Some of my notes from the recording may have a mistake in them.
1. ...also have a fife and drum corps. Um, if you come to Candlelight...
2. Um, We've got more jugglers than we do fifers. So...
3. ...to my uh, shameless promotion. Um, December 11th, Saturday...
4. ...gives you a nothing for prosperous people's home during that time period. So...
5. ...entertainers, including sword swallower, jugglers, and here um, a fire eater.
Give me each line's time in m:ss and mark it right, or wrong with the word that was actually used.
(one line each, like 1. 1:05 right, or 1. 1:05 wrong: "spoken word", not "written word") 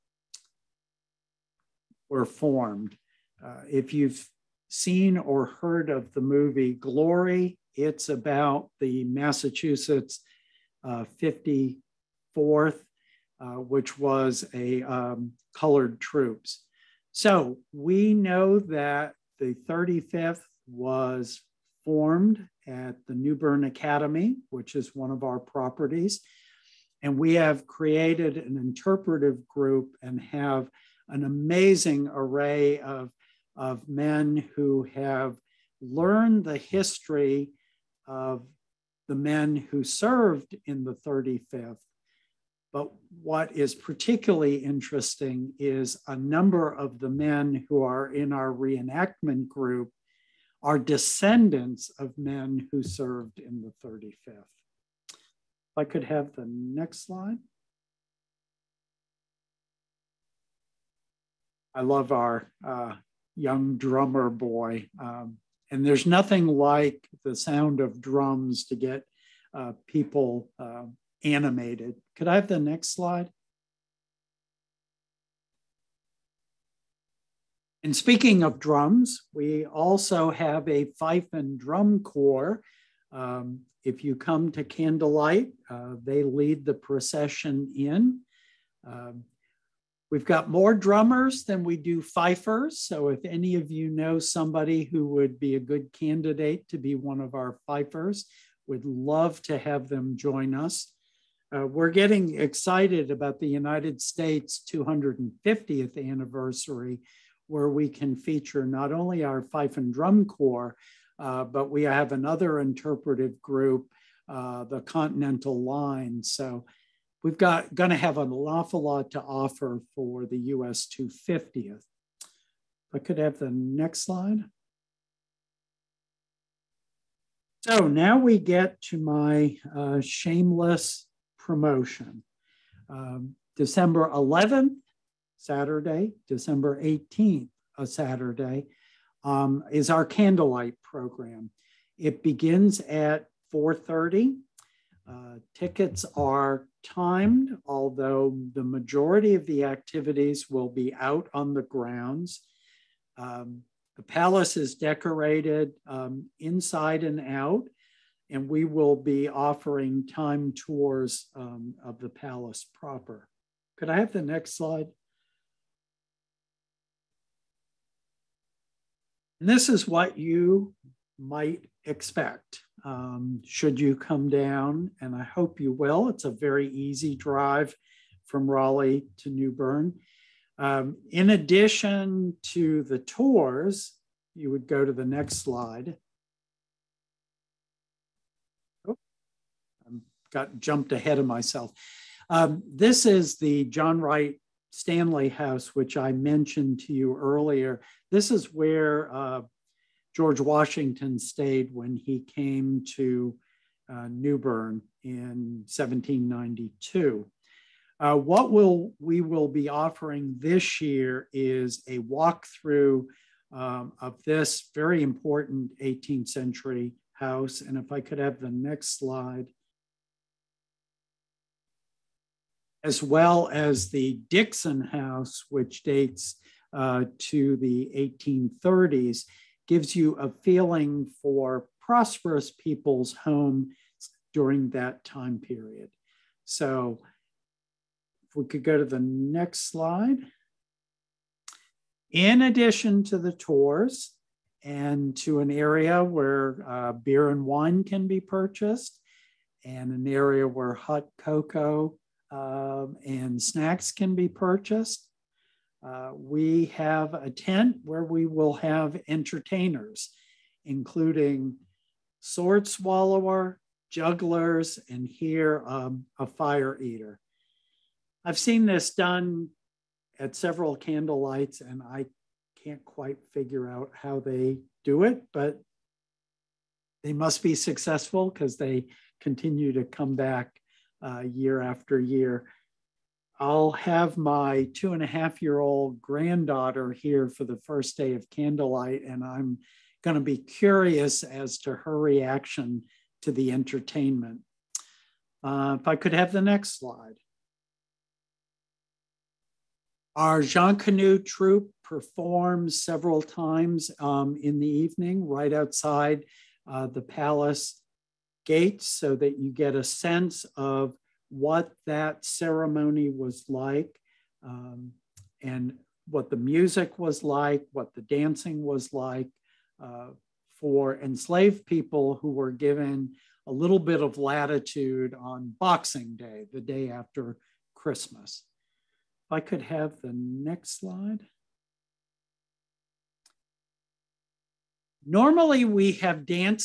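1. 1:19 right
2. 1:28 wrong: "drummers", not "jugglers"
3. 2:08 right
4. 3:49 wrong: "feeling", not "nothing"
5. 4:19 right.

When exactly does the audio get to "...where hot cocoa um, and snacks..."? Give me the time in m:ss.
4:10.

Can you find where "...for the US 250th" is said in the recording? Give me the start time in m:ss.
1:59.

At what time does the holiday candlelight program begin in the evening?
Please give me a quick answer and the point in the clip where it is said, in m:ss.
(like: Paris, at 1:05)
4:30, at 2:23.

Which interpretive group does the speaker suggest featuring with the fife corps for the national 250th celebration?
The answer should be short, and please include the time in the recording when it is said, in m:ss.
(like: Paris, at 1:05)
Continental Line, at 1:54.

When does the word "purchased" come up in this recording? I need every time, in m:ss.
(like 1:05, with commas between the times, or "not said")
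4:08, 4:14.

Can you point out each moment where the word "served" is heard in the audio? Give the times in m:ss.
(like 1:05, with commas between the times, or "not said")
0:39, 0:52.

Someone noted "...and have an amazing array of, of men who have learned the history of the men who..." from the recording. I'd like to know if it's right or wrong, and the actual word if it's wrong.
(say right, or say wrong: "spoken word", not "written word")
right.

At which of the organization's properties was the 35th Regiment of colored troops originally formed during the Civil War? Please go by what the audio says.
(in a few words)
New Bern Academy.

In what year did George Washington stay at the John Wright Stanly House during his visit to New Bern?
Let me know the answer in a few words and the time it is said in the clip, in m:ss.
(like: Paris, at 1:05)
1792, at 3:25.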